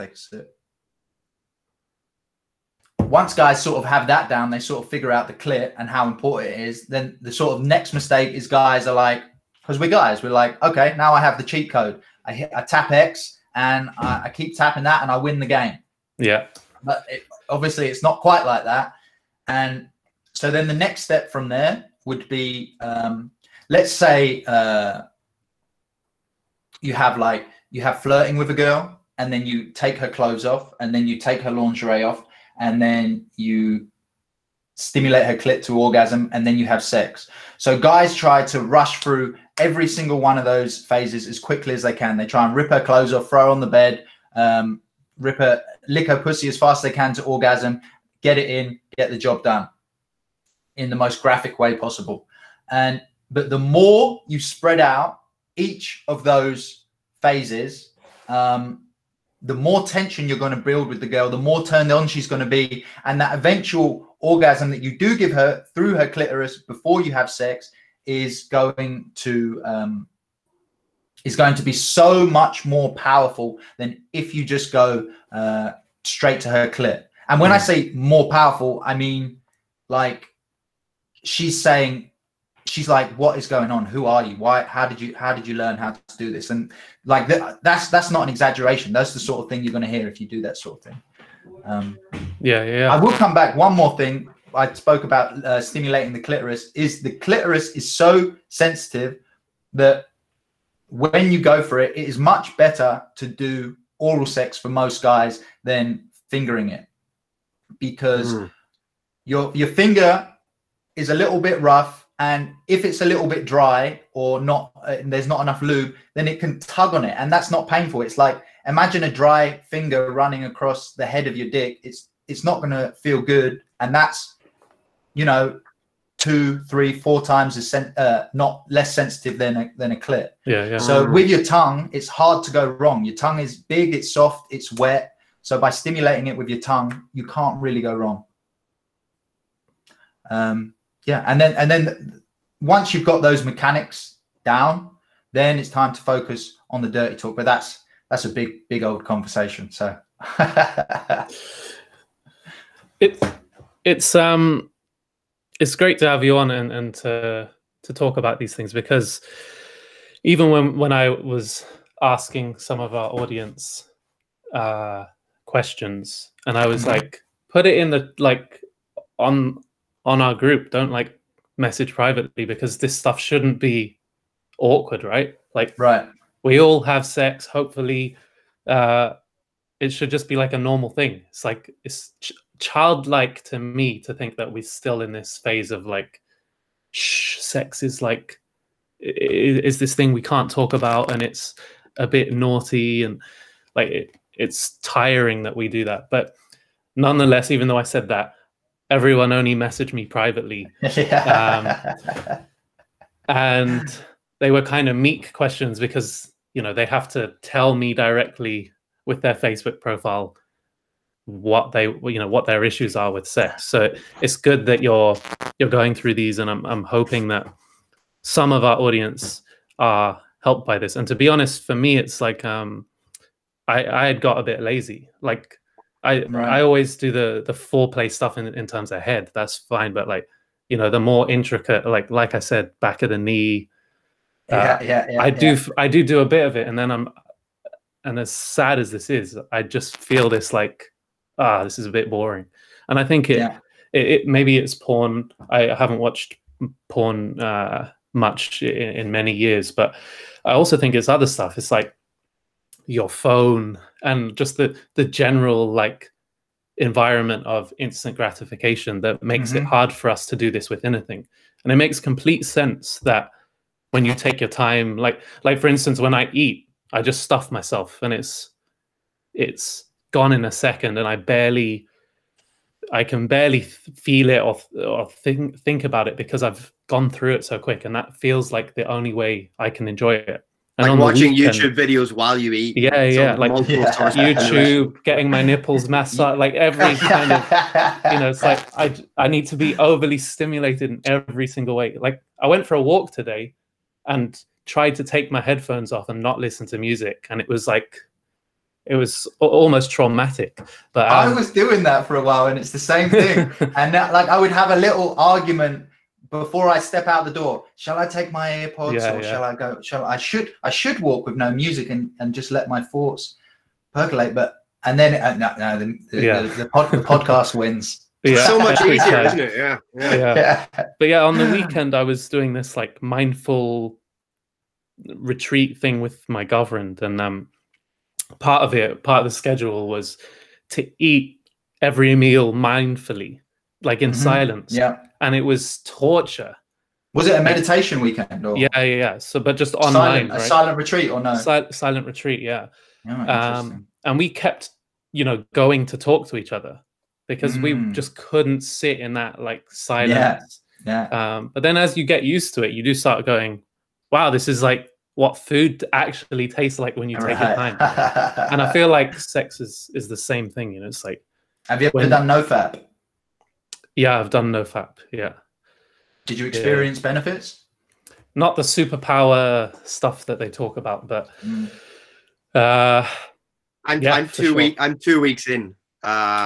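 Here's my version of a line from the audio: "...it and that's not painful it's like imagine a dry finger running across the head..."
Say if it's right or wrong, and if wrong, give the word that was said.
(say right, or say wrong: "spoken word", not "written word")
right.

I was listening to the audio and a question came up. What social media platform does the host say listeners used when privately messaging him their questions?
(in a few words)
Facebook.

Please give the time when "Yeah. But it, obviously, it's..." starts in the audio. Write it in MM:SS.
00:16.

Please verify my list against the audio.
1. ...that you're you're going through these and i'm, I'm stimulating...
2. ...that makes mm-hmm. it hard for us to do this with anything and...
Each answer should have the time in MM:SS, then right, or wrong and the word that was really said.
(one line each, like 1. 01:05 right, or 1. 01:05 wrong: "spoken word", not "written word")
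1. 03:34 wrong: "hoping", not "stimulating"
2. 04:19 right.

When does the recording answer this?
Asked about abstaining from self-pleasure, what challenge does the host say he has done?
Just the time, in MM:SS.
06:04.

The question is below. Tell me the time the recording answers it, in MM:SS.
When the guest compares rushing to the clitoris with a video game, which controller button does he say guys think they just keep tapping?
00:12.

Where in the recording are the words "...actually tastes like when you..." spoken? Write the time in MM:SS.
05:55.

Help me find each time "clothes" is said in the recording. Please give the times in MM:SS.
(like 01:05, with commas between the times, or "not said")
00:30, 00:42.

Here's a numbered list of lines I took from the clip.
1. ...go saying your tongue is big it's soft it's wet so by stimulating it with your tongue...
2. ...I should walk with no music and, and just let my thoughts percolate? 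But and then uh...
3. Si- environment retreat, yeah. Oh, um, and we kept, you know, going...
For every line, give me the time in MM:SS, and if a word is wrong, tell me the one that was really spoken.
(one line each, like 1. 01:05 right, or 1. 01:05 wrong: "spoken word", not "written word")
1. 02:12 wrong: "wrong", not "saying"
2. 05:10 right
3. 05:41 wrong: "silent", not "environment".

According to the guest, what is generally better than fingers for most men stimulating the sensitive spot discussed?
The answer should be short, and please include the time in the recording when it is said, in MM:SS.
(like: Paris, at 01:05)
Oral sex, at 01:43.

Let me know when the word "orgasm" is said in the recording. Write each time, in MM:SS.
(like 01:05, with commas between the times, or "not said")
00:35, 00:47, 01:04.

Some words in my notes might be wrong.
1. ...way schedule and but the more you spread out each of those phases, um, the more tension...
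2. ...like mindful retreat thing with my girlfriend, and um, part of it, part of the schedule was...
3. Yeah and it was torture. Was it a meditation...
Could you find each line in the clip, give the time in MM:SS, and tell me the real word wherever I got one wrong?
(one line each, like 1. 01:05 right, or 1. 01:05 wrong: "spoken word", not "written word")
1. 00:51 wrong: "possible", not "schedule"
2. 05:22 right
3. 05:34 right.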